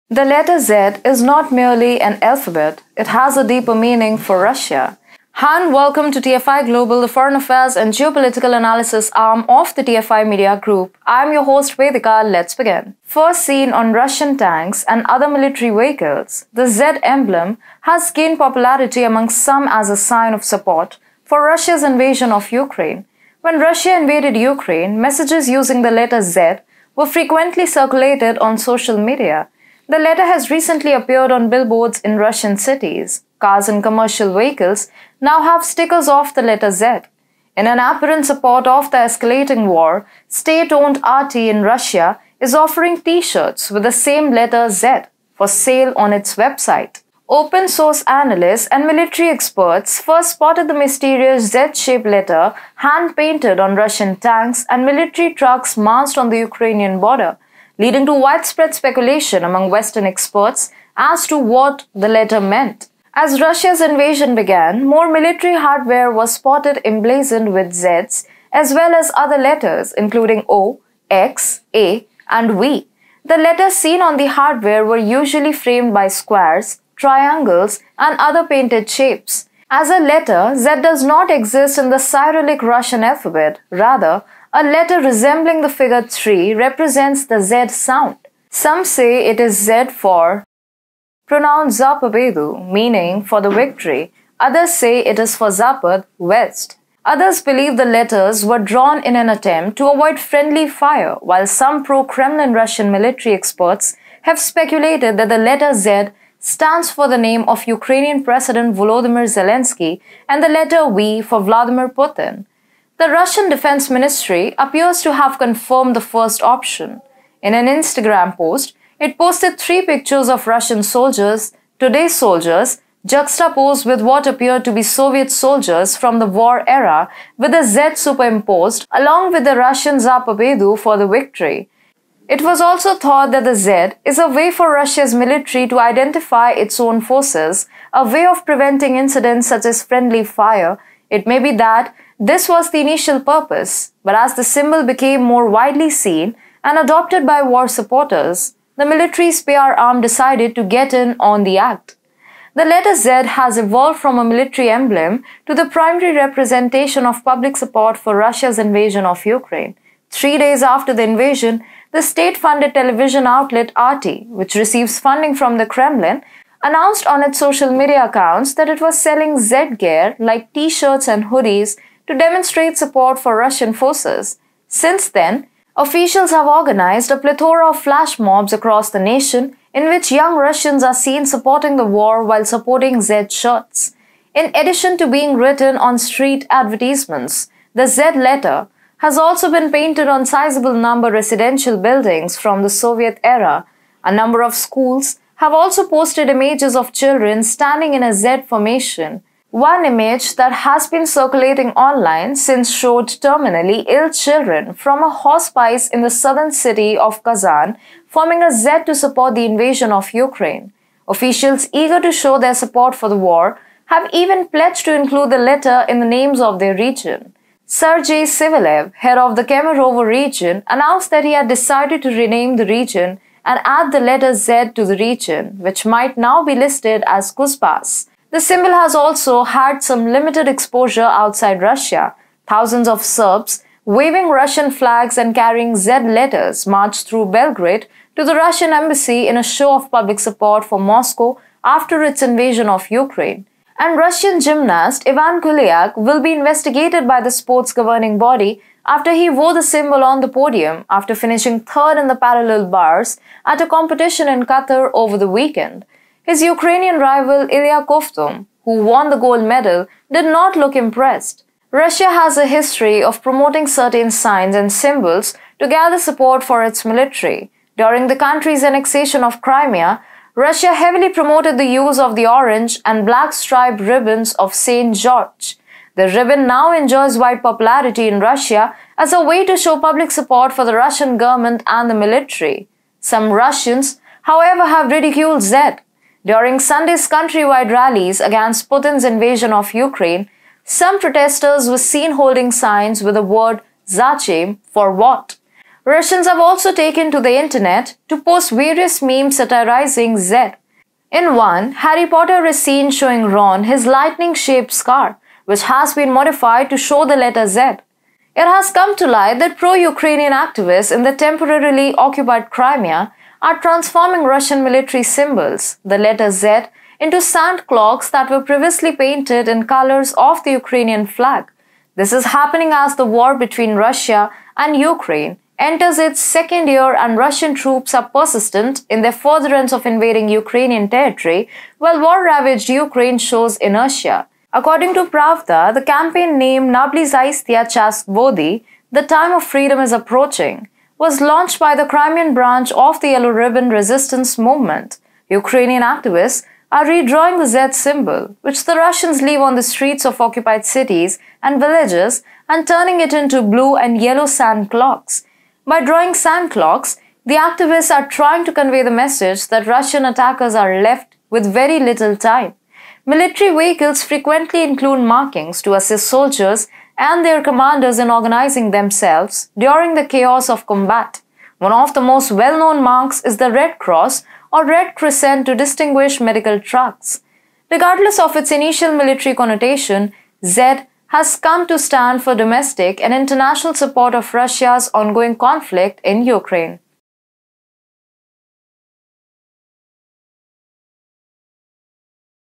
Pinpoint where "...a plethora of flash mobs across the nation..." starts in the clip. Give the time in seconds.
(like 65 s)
177 s.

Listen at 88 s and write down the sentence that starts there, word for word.
Some say it is Z for Pronoun Zapabedu, meaning for the victory.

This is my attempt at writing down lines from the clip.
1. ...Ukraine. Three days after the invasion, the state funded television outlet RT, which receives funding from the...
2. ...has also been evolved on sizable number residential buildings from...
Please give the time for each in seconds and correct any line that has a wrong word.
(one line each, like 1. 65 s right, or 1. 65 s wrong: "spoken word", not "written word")
1. 159 s right
2. 188 s wrong: "painted", not "evolved".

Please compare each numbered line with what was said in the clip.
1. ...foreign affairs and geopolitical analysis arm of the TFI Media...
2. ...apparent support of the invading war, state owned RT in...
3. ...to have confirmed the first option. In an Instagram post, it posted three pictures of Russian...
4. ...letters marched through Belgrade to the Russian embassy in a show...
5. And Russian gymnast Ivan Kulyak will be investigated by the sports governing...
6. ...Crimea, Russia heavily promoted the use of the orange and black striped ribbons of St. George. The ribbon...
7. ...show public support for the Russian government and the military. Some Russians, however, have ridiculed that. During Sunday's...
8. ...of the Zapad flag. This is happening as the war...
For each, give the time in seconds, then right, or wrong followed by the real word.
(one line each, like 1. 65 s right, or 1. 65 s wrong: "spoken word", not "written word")
1. 7 s right
2. 37 s wrong: "escalating", not "invading"
3. 115 s right
4. 236 s right
5. 243 s right
6. 269 s right
7. 279 s right
8. 320 s wrong: "Ukrainian", not "Zapad".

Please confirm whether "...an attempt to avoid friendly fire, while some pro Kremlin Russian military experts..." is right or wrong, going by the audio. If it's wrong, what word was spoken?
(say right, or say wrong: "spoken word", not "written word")
right.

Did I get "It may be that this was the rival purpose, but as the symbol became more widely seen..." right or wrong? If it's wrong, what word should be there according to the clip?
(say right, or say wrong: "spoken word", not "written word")
wrong: "initial", not "rival".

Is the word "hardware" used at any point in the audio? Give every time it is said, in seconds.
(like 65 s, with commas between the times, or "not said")
65 s, 74 s.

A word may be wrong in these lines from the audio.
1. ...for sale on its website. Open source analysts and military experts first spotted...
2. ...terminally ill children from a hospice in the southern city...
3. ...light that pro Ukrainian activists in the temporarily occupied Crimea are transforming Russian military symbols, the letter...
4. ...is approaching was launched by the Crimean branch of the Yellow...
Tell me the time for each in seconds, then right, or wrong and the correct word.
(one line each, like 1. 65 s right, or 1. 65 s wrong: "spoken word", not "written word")
1. 45 s right
2. 203 s right
3. 309 s right
4. 339 s right.